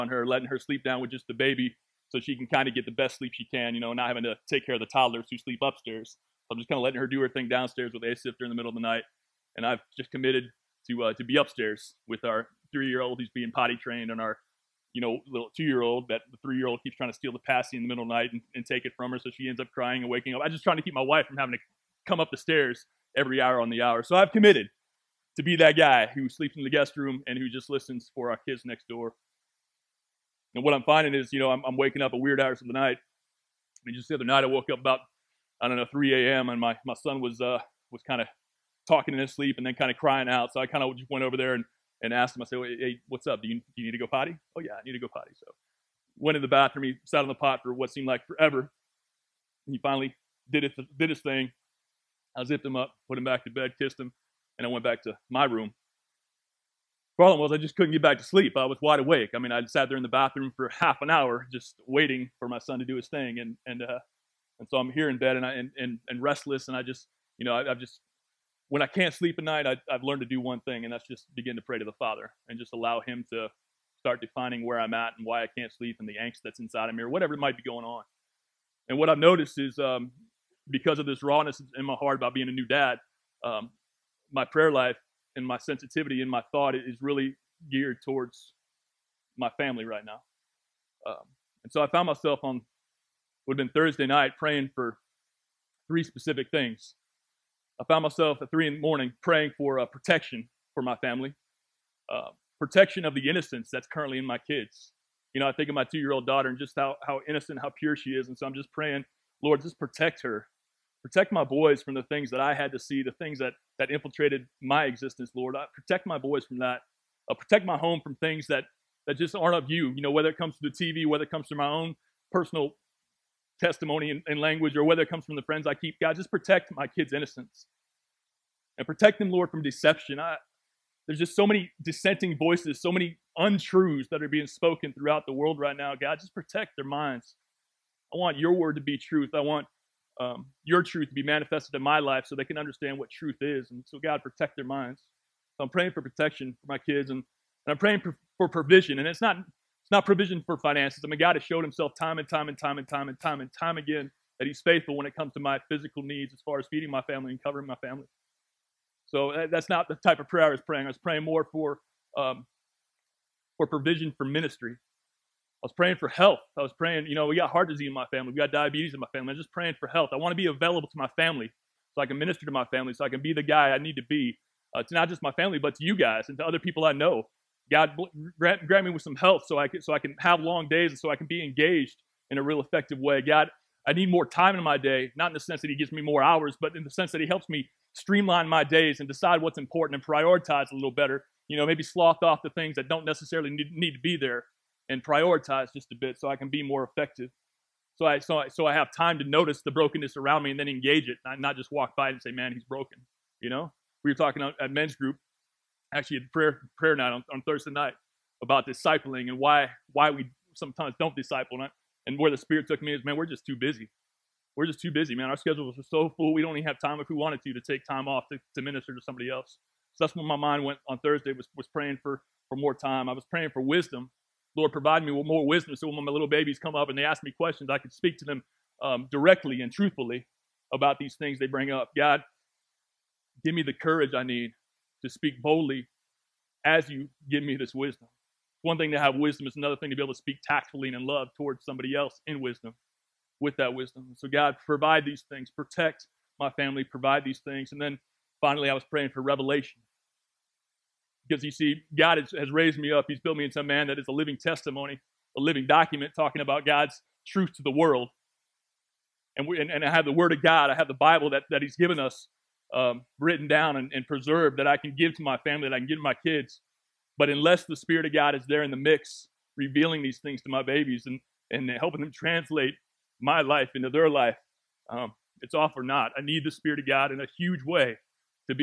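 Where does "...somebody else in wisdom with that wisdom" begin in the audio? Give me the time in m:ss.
4:01.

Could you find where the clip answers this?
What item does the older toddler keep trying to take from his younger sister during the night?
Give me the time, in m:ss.
0:17.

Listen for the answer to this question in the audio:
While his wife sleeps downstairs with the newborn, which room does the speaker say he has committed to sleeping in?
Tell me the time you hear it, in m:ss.
0:26.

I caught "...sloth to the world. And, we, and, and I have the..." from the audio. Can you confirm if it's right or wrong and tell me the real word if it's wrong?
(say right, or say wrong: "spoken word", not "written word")
wrong: "truth", not "sloth".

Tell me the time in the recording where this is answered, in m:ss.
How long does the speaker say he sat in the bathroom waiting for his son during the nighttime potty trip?
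1:00.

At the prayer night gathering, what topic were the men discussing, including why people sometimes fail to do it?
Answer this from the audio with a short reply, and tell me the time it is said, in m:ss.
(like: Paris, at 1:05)
discipling, at 3:28.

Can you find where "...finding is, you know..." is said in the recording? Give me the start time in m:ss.
0:30.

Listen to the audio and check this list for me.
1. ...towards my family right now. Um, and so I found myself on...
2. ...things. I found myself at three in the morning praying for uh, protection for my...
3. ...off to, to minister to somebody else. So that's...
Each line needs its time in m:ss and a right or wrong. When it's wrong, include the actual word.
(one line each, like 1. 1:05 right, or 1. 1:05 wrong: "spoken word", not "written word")
1. 1:28 right
2. 1:36 right
3. 3:38 right.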